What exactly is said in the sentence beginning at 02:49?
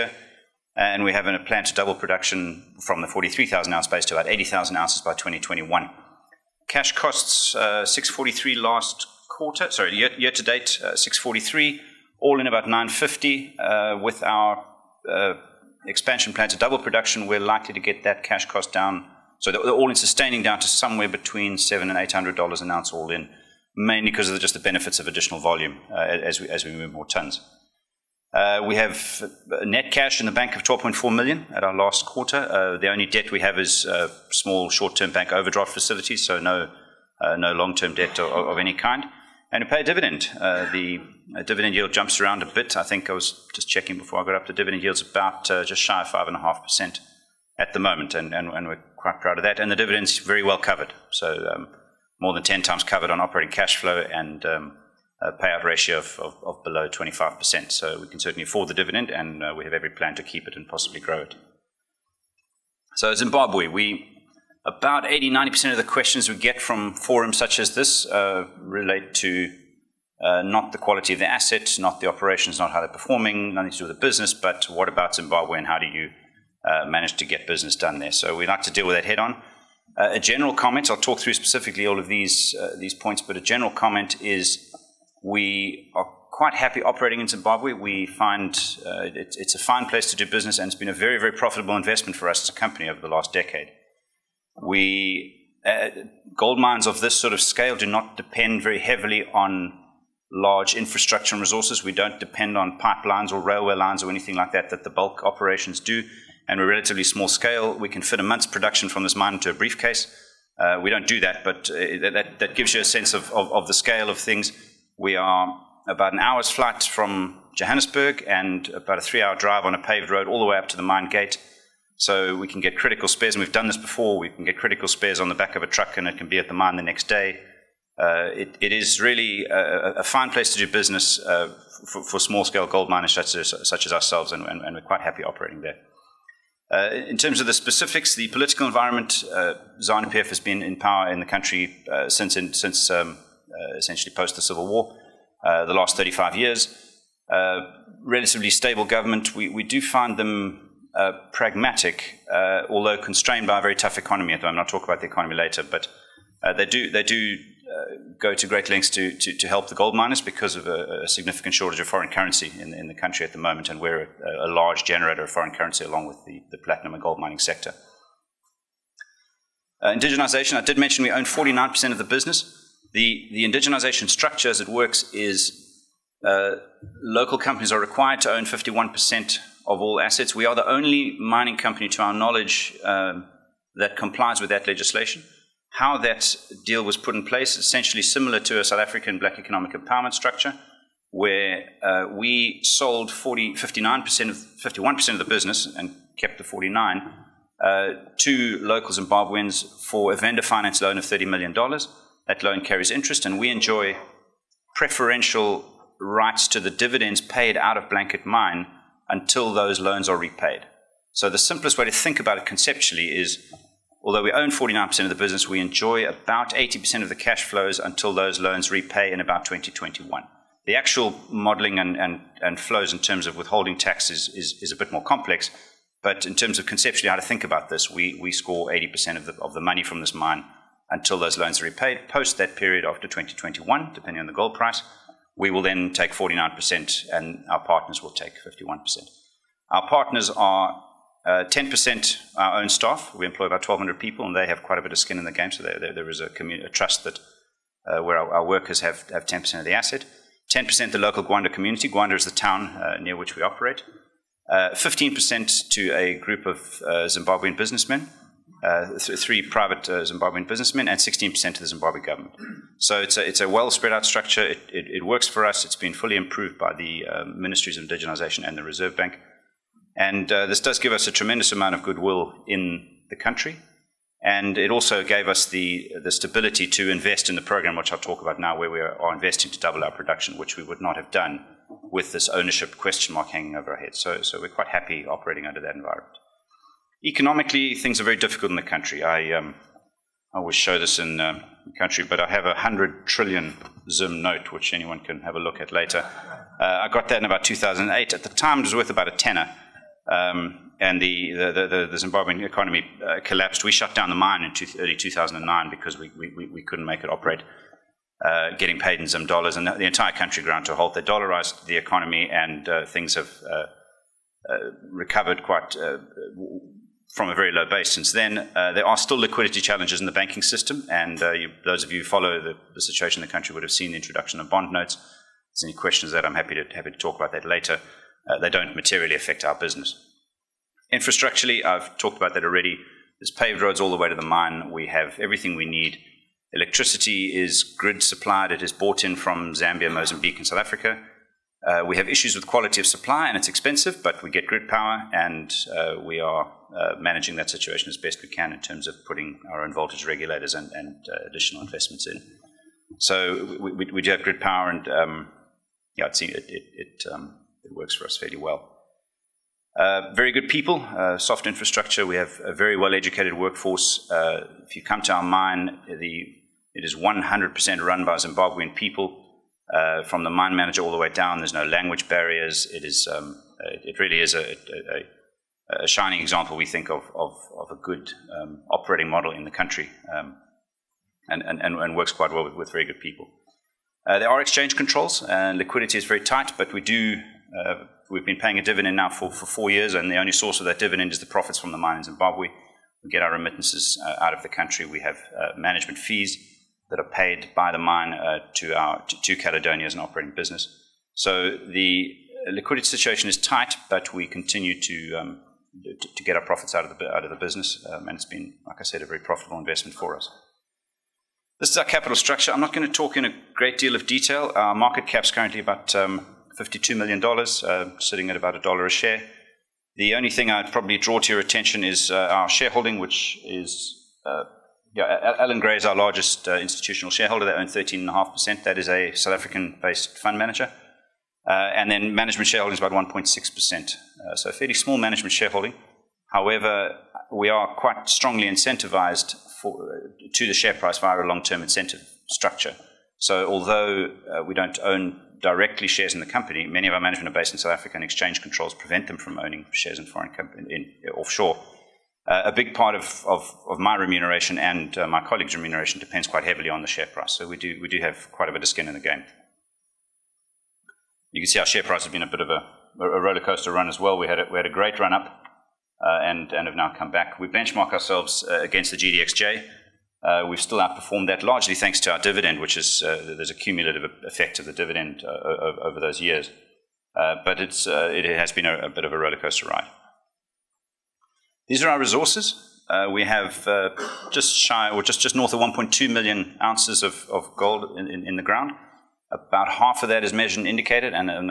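Uh, indigenization, I did mention we own 49% of the business.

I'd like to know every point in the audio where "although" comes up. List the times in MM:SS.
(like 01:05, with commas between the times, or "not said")
02:32, 03:34, 07:23.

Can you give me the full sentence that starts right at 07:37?
So we do, we do have quite a bit of skin in the game.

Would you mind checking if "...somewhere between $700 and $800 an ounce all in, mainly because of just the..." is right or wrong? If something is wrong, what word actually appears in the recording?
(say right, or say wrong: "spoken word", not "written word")
right.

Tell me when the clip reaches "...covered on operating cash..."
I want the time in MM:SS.
00:52.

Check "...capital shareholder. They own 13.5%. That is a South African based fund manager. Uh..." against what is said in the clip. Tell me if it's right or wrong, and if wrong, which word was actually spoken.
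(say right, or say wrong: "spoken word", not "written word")
wrong: "institutional", not "capital".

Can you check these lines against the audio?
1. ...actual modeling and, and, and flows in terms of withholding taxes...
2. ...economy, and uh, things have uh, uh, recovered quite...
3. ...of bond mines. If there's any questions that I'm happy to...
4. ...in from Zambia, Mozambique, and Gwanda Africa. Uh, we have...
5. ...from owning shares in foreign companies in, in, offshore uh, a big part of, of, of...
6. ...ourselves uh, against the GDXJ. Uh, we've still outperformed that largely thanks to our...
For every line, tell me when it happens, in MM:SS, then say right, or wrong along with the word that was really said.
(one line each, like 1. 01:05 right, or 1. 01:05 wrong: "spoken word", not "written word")
1. 03:40 right
2. 05:11 right
3. 05:24 wrong: "notes", not "mines"
4. 05:39 wrong: "South", not "Gwanda"
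5. 07:29 right
6. 07:47 right.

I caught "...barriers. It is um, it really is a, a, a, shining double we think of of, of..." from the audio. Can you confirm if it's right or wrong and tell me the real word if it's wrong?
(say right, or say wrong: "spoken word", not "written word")
wrong: "example", not "double".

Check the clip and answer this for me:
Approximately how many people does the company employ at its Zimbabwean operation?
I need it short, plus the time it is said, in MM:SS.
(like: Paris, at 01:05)
1,200, at 04:03.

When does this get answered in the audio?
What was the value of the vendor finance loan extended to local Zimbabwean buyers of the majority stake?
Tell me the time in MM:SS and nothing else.
03:21.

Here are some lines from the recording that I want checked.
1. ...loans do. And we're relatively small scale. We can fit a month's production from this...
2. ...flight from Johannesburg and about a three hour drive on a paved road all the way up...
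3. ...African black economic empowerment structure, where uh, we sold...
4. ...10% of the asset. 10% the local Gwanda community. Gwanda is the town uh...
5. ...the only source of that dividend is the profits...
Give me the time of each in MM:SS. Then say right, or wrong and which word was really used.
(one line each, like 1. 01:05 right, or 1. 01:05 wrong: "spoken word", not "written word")
1. 01:45 wrong: "operations", not "loans"
2. 01:56 right
3. 03:08 right
4. 04:09 right
5. 06:30 right.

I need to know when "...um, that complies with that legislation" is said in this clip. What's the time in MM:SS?
03:02.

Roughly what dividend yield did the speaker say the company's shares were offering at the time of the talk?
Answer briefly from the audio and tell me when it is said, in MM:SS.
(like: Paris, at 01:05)
5.5%, at 00:46.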